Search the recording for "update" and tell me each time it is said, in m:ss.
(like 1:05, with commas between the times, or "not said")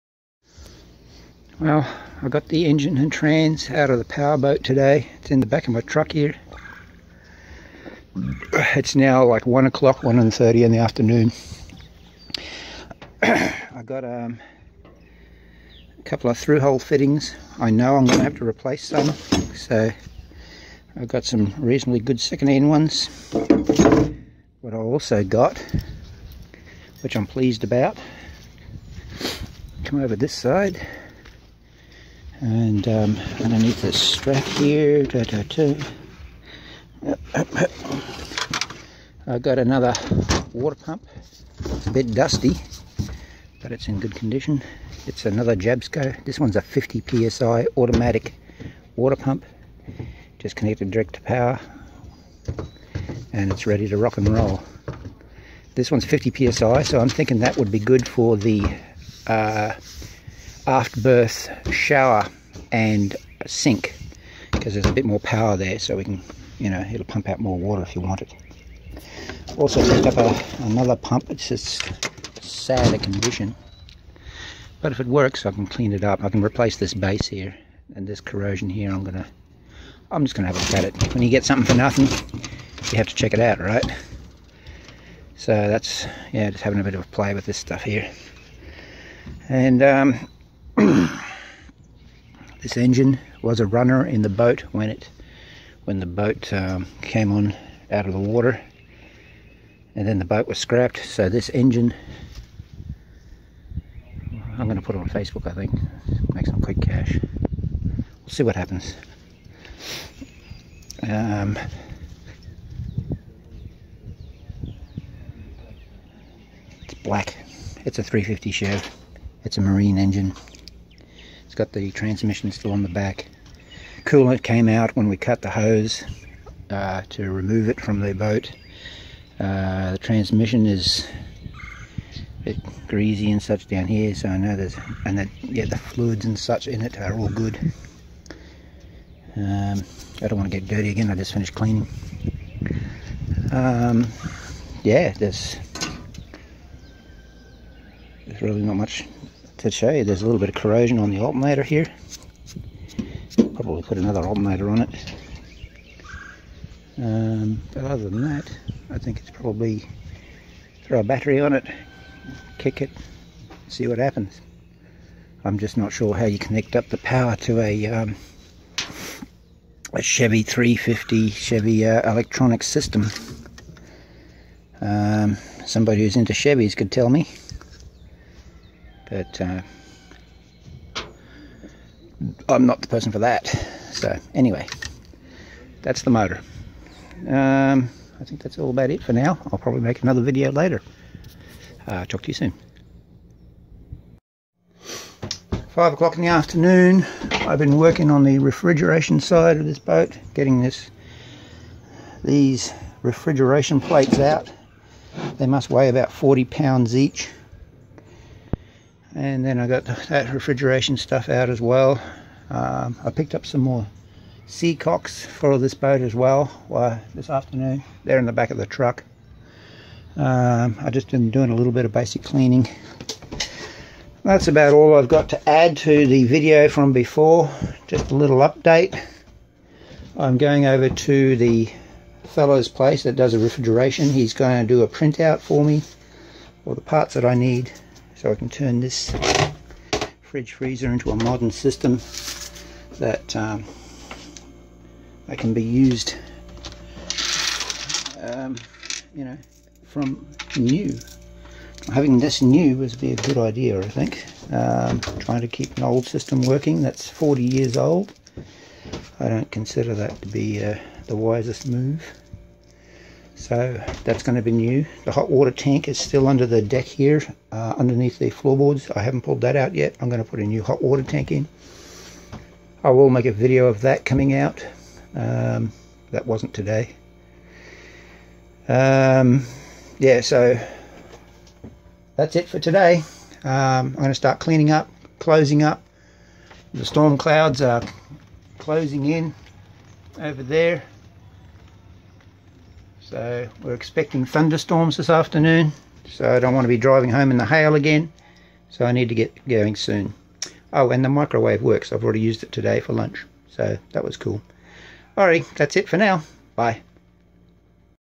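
3:48.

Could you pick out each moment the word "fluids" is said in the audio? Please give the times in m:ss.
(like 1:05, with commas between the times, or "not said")
2:15.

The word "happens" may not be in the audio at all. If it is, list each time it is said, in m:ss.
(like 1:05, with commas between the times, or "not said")
1:48, 2:43.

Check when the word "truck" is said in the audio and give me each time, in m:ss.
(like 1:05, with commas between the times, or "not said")
0:05, 3:38.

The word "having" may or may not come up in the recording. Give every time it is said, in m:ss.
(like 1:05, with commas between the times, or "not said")
1:26, 4:11.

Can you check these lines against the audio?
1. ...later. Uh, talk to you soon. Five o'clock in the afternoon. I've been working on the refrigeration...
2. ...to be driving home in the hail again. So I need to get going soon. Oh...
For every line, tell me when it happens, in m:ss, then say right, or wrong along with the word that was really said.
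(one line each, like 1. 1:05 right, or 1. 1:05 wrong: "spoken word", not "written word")
1. 3:10 right
2. 4:56 right.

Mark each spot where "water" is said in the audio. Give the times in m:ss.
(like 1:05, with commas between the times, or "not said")
0:40, 0:48, 1:07, 1:38, 4:25, 4:30.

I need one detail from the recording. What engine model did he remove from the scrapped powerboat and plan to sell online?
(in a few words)
350 Chev.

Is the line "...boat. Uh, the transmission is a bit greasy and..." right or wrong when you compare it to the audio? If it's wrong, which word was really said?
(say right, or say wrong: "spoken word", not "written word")
right.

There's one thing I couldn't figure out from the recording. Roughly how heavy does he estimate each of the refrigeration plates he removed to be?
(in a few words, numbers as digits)
40 pounds.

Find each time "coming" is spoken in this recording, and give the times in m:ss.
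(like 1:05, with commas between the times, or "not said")
4:34.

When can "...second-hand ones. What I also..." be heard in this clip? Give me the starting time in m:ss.
0:22.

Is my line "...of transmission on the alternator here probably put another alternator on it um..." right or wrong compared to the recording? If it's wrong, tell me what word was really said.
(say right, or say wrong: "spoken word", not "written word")
wrong: "corrosion", not "transmission".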